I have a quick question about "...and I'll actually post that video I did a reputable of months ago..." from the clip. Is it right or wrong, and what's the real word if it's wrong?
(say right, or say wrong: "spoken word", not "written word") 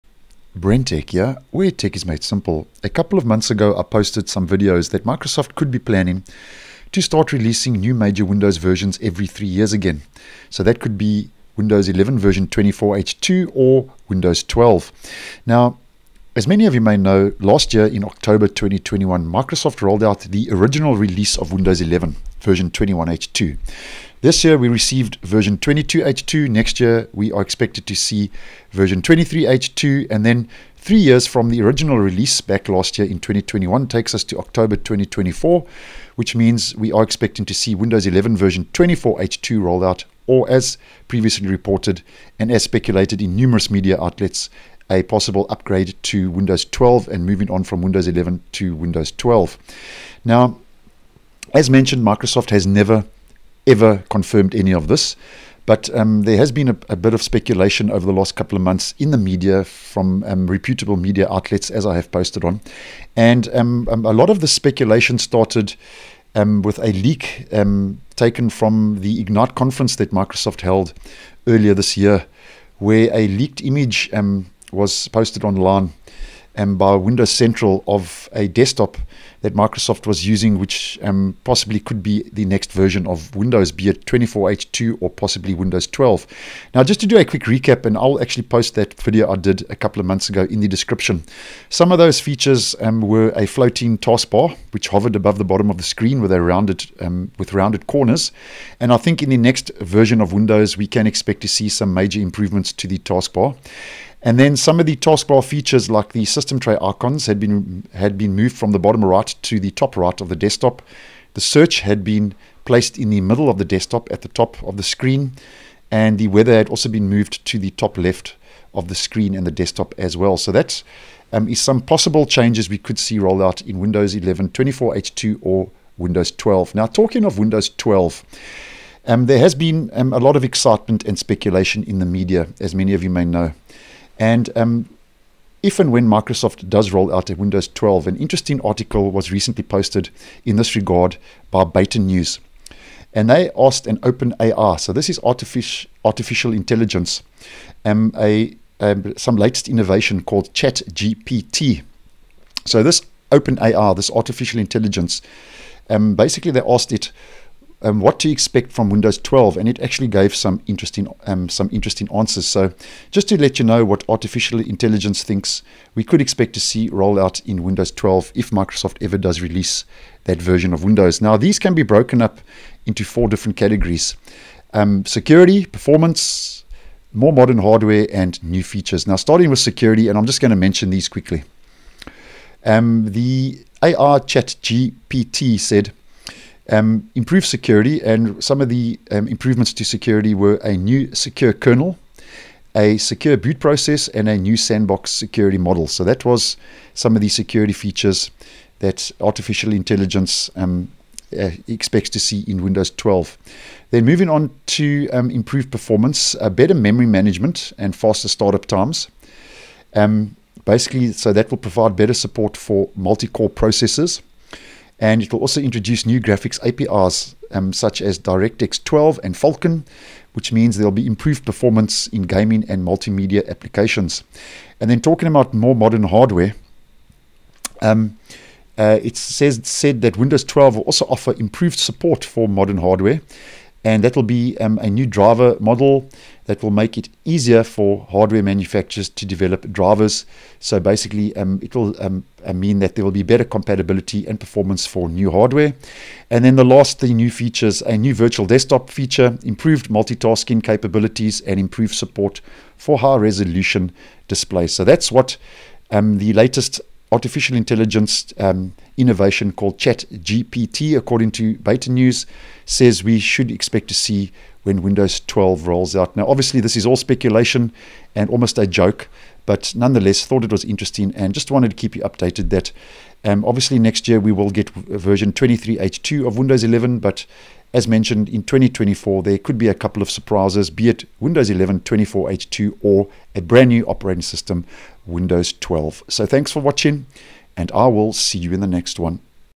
wrong: "couple", not "reputable".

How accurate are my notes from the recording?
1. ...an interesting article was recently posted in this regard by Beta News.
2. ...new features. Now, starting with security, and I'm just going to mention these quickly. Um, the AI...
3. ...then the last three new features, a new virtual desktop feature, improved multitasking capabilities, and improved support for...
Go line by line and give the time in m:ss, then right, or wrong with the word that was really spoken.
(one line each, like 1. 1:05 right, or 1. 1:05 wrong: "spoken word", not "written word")
1. 2:18 right
2. 2:58 right
3. 4:06 right.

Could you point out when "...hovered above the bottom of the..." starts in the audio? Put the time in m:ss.
1:34.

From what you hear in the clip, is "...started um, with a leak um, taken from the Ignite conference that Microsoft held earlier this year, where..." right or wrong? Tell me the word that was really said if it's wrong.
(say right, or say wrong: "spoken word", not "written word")
right.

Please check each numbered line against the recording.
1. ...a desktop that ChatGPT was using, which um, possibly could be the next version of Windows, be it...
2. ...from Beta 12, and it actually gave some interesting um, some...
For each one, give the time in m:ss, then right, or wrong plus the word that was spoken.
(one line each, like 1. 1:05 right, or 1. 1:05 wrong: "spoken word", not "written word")
1. 1:18 wrong: "Microsoft", not "ChatGPT"
2. 2:38 wrong: "Windows", not "Beta".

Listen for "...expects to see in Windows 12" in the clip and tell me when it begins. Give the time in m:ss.
3:21.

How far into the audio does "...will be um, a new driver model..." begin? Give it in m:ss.
3:54.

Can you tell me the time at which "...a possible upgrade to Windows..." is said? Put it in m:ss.
0:44.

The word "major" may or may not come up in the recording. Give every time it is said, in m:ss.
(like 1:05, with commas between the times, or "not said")
0:07, 1:41.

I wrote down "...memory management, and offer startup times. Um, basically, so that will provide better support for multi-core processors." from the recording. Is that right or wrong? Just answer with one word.
wrong.